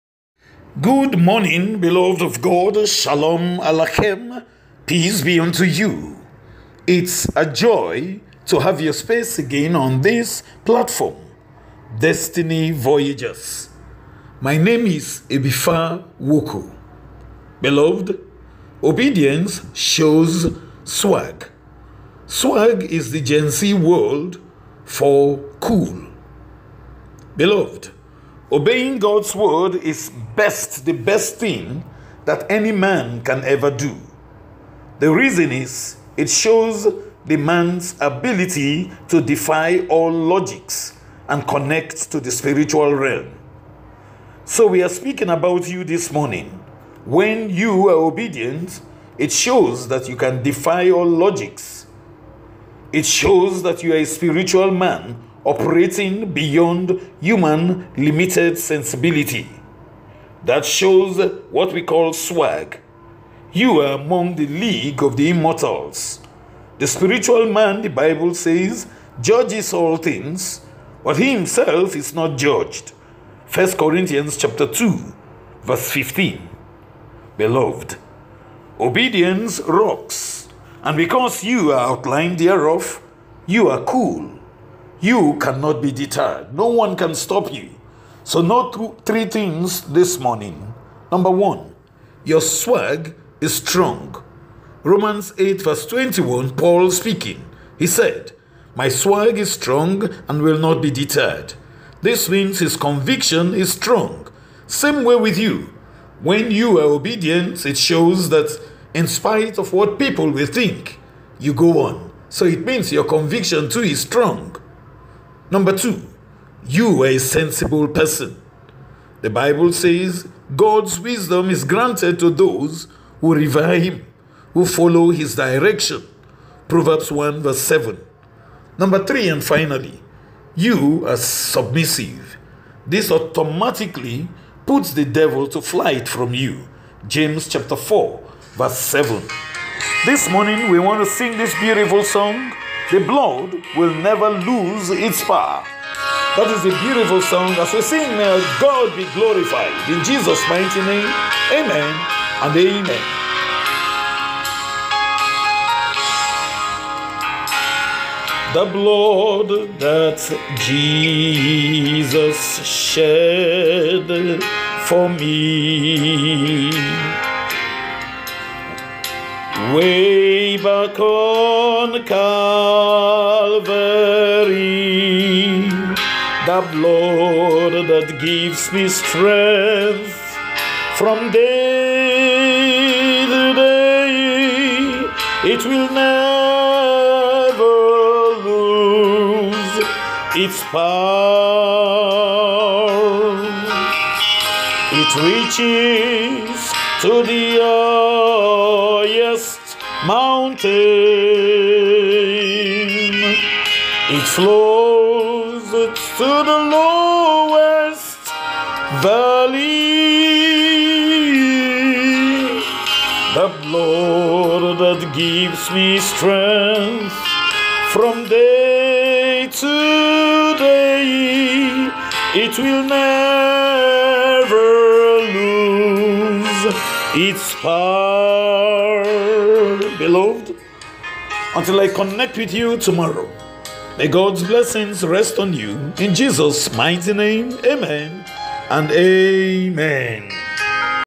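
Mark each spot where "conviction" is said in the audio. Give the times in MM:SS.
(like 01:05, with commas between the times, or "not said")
01:42, 01:53.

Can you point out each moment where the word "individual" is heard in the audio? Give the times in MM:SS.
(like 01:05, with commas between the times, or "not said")
not said.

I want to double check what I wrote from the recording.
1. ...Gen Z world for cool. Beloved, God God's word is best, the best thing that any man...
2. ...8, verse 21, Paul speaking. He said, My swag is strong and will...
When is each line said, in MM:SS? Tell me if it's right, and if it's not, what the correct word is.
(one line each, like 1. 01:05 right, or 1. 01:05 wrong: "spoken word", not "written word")
1. 00:23 wrong: "Obeying", not "God"
2. 01:35 right.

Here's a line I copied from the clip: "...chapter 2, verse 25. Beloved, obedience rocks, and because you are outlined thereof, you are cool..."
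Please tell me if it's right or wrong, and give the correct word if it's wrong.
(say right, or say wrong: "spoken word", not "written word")
wrong: "15", not "25".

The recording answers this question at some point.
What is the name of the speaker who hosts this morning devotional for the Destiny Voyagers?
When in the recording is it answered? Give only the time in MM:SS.
00:15.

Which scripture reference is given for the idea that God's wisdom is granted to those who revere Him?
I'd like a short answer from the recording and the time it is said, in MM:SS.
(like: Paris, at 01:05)
Proverbs 1:7, at 02:06.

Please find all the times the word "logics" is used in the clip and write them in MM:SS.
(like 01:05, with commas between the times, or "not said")
00:40, 00:51.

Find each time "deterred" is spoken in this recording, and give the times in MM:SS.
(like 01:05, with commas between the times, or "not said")
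01:25, 01:40.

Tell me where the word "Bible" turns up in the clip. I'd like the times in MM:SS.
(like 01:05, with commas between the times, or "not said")
01:07, 01:59.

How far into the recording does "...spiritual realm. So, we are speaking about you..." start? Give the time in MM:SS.
00:42.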